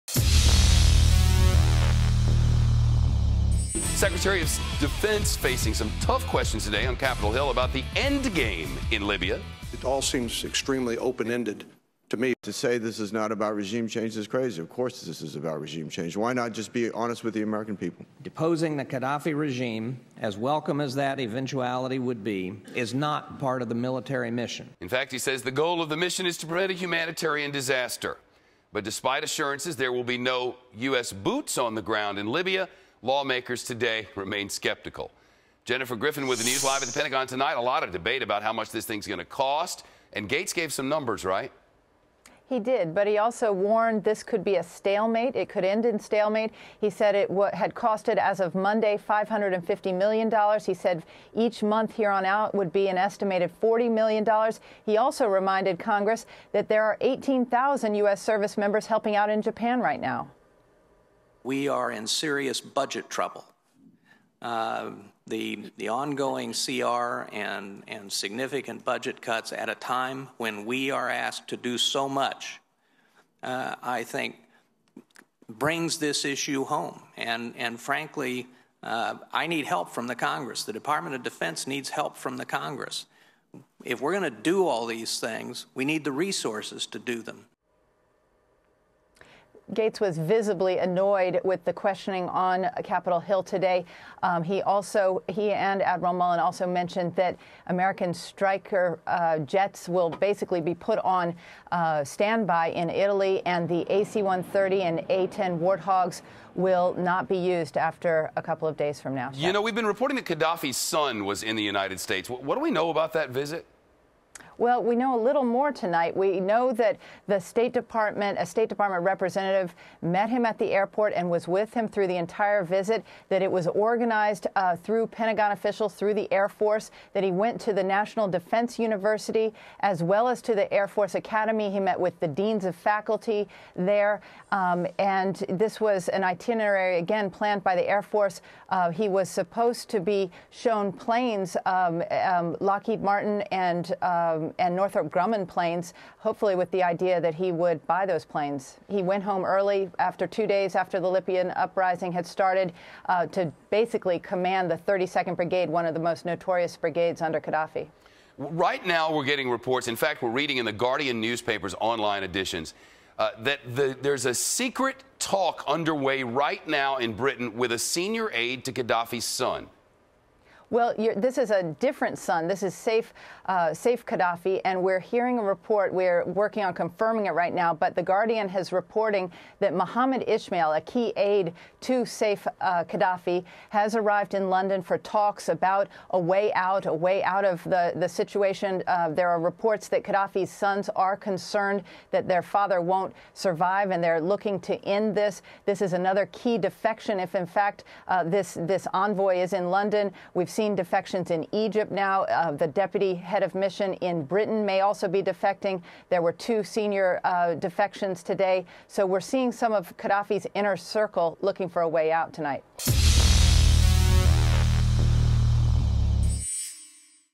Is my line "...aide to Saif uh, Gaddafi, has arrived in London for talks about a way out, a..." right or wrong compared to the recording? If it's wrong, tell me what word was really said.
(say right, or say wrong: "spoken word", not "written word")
right.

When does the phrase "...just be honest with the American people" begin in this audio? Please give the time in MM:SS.
00:16.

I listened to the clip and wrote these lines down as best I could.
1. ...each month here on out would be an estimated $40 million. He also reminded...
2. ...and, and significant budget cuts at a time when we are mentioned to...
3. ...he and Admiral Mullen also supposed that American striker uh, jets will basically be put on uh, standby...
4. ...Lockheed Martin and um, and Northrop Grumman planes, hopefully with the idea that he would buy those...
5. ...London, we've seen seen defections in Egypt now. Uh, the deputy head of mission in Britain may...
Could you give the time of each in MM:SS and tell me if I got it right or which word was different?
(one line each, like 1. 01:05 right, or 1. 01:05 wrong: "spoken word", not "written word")
1. 00:51 right
2. 01:07 wrong: "asked", not "mentioned"
3. 01:35 wrong: "mentioned", not "supposed"
4. 02:22 right
5. 03:19 right.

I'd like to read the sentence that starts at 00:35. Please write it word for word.
Jennifer Griffin with the news live at the Pentagon tonight.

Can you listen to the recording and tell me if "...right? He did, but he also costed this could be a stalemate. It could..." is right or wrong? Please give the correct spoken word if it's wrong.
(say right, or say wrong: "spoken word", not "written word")
wrong: "warned", not "costed".